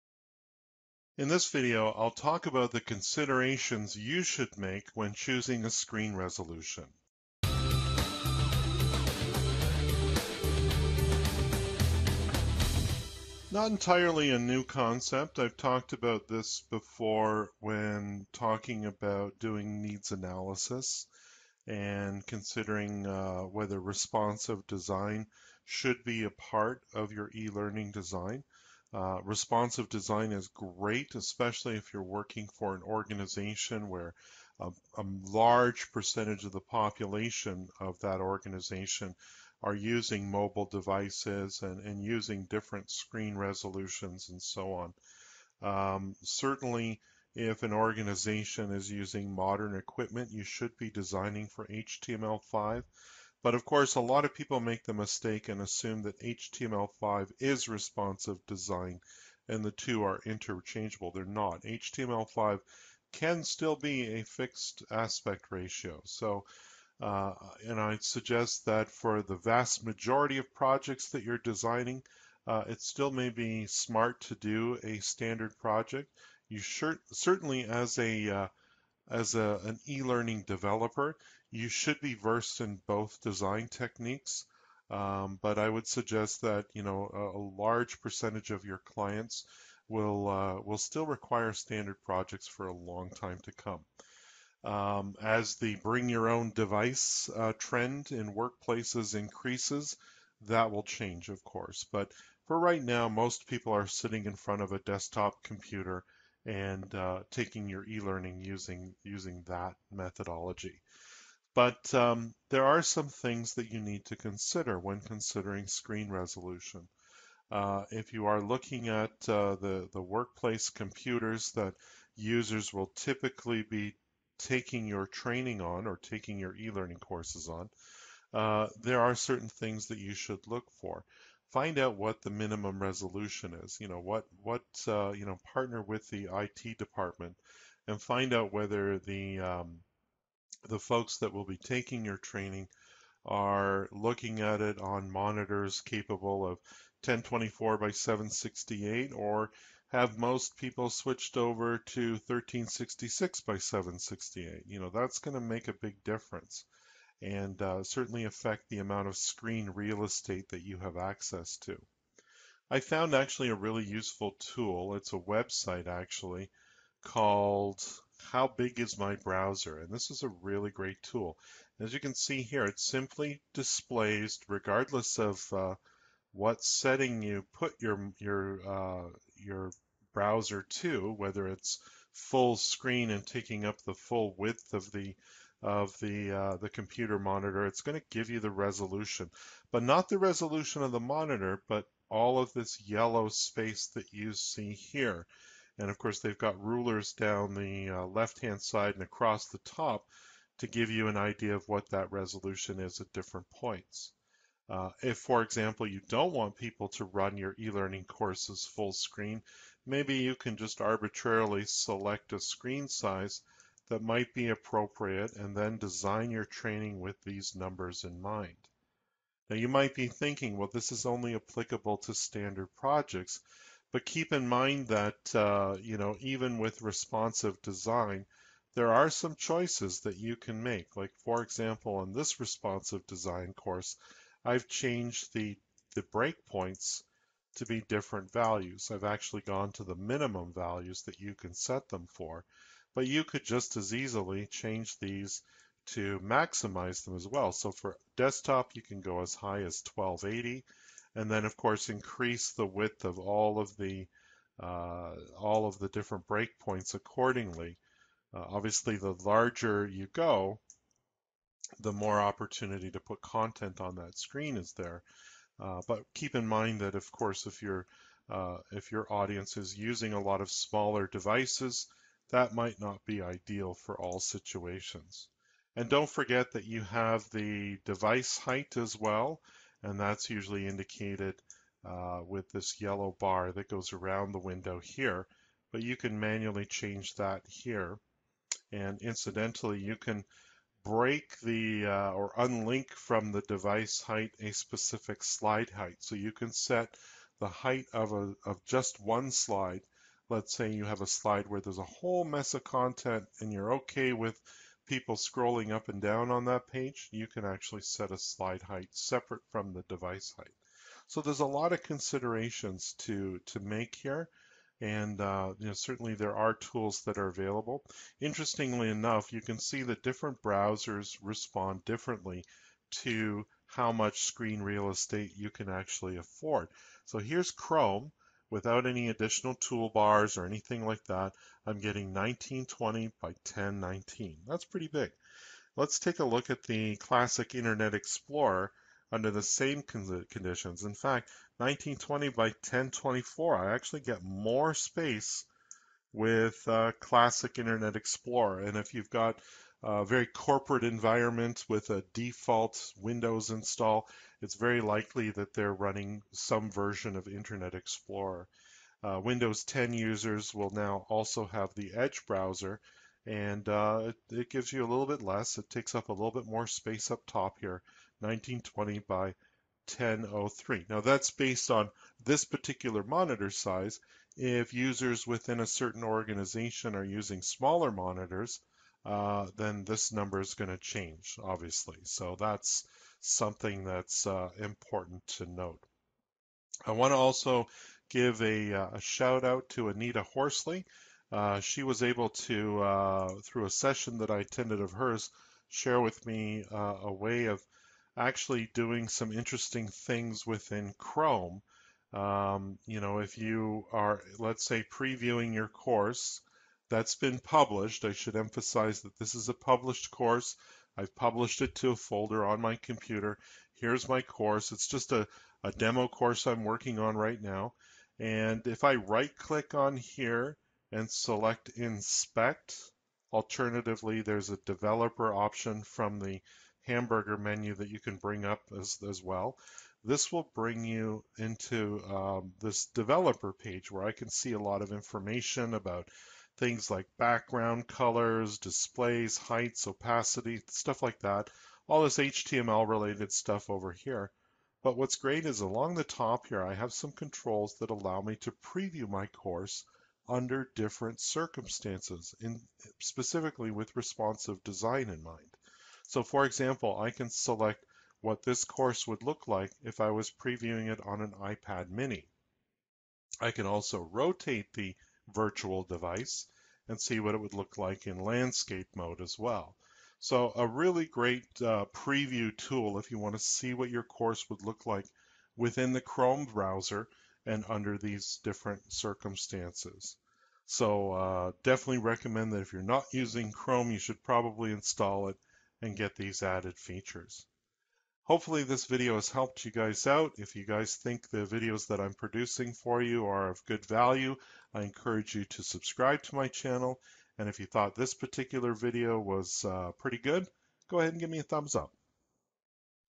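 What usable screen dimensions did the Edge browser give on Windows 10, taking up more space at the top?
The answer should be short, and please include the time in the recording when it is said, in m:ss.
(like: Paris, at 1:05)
1920 by 1003, at 6:08.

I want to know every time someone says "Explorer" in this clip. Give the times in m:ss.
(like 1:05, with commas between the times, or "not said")
5:37, 5:47, 5:57.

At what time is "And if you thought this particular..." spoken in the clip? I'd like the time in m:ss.
8:17.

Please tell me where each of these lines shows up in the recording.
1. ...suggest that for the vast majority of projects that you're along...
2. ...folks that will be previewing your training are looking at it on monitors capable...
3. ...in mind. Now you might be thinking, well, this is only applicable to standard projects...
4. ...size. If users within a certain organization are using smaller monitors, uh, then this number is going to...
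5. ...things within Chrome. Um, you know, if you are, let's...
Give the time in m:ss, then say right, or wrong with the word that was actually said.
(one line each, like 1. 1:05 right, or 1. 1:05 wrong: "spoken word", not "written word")
1. 1:07 wrong: "designing", not "along"
2. 2:20 wrong: "taking", not "previewing"
3. 3:38 right
4. 6:13 right
5. 6:39 right.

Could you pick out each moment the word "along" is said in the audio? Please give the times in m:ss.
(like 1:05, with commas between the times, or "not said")
7:25.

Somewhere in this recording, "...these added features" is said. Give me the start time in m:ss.
8:06.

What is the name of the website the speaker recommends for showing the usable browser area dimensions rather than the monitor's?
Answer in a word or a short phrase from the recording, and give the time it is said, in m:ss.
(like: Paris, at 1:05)
How Big Is My Browser?, at 2:48.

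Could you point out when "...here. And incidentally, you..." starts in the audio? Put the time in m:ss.
4:47.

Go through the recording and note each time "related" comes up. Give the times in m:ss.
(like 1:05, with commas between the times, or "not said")
7:22.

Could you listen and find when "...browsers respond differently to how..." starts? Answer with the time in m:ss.
5:20.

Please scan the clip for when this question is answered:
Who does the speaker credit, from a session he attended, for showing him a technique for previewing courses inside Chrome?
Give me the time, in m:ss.
6:29.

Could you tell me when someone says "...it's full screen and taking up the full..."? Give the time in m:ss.
3:01.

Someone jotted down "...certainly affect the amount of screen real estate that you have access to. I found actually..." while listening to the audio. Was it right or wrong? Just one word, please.
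right.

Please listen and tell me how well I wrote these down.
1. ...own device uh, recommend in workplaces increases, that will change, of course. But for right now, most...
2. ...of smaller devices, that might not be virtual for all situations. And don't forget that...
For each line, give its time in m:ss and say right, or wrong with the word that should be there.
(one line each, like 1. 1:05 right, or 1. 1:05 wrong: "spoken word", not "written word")
1. 1:36 wrong: "trend", not "recommend"
2. 4:30 wrong: "ideal", not "virtual".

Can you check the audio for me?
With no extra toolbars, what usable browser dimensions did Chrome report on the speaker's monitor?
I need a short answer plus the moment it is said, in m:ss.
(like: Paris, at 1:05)
1920 by 1019, at 5:32.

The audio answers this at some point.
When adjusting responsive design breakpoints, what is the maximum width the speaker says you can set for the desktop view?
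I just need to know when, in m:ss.
4:09.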